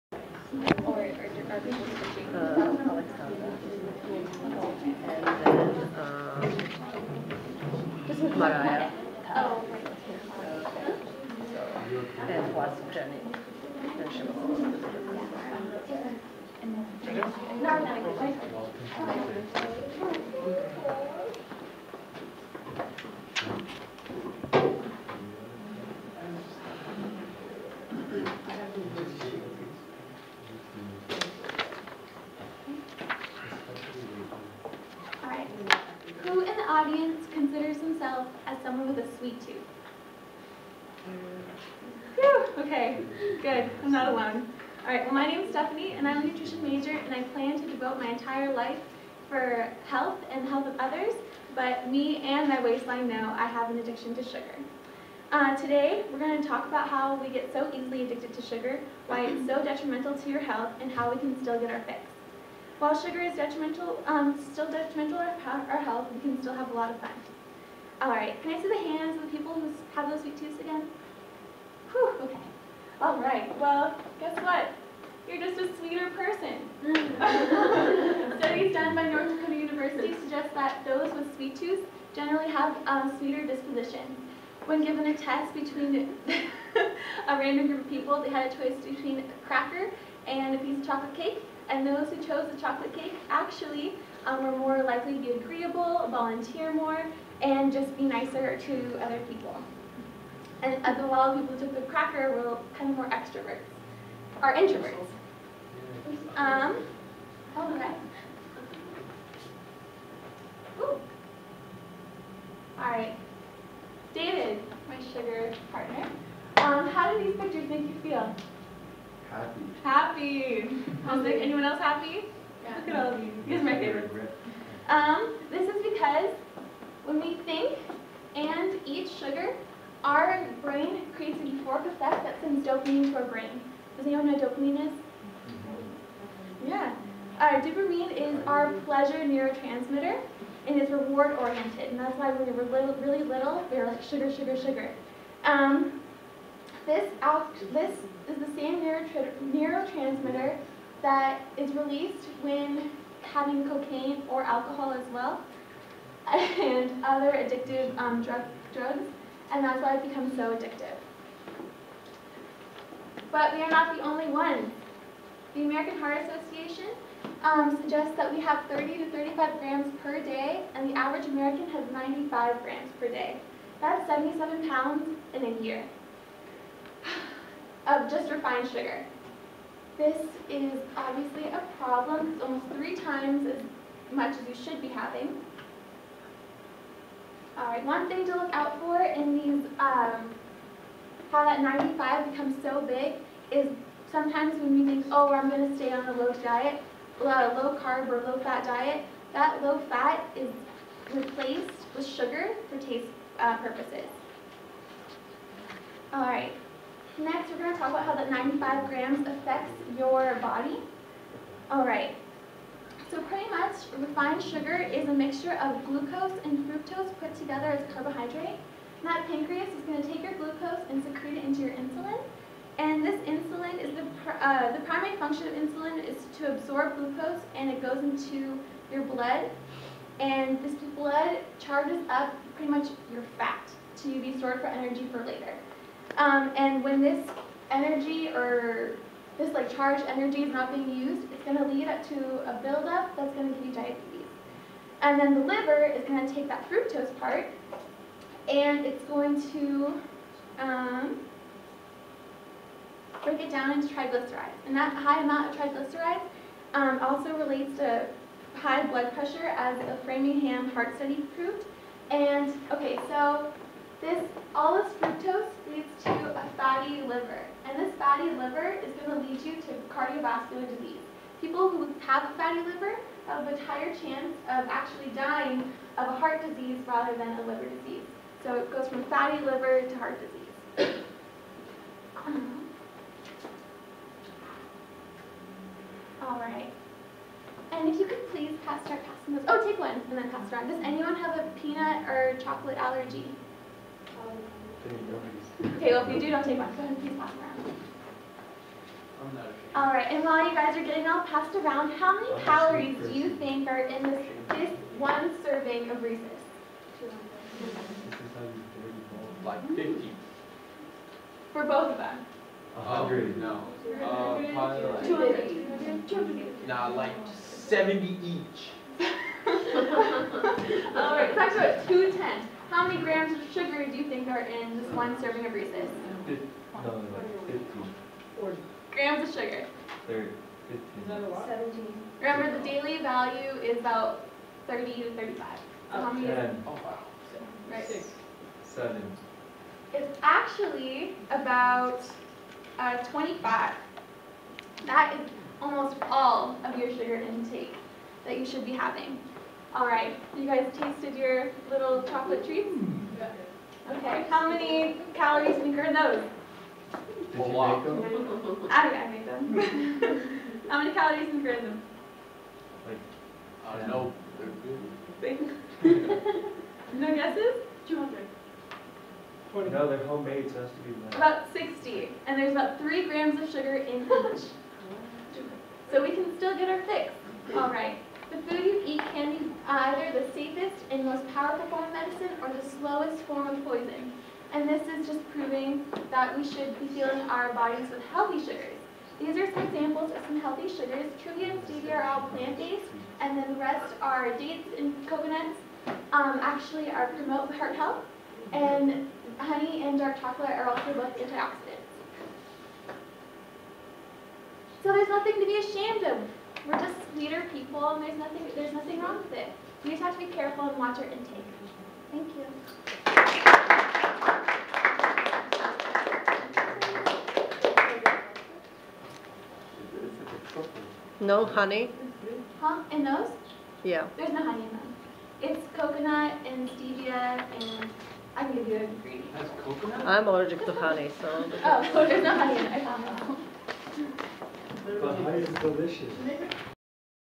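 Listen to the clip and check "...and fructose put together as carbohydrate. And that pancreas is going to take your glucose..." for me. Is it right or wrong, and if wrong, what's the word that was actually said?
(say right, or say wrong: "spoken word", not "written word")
right.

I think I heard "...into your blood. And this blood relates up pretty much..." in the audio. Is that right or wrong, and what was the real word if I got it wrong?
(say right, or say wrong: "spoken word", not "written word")
wrong: "charges", not "relates".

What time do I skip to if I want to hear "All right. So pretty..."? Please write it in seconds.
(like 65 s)
211 s.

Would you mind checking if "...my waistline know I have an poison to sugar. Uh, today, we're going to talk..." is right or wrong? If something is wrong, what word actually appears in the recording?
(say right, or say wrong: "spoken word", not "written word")
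wrong: "addiction", not "poison".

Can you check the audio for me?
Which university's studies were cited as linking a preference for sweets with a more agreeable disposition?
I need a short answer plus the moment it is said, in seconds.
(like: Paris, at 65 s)
North Dakota University, at 79 s.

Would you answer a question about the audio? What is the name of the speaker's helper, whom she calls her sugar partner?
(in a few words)
David.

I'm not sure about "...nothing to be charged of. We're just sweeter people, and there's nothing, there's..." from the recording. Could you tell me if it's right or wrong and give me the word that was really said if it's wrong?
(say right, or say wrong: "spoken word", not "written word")
wrong: "ashamed", not "charged".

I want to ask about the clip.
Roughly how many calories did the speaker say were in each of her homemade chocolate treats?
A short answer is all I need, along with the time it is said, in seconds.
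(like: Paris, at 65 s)
About 60, at 371 s.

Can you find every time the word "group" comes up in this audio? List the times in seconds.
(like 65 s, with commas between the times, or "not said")
87 s.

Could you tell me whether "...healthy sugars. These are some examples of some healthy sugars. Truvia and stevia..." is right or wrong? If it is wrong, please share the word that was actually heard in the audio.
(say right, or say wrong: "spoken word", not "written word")
right.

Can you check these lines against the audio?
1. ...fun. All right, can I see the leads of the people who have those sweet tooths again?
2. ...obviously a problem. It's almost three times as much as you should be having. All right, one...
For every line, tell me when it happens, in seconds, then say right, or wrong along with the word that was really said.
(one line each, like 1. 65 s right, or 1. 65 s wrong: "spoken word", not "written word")
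1. 66 s wrong: "hands", not "leads"
2. 180 s right.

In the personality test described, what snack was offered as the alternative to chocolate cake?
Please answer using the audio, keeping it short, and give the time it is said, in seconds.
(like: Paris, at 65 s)
A cracker, at 89 s.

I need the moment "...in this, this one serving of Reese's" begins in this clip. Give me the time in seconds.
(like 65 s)
303 s.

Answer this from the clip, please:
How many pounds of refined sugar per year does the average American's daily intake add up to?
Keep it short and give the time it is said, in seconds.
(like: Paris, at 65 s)
77 pounds, at 174 s.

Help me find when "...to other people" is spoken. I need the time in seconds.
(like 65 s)
98 s.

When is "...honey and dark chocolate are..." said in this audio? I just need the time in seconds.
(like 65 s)
399 s.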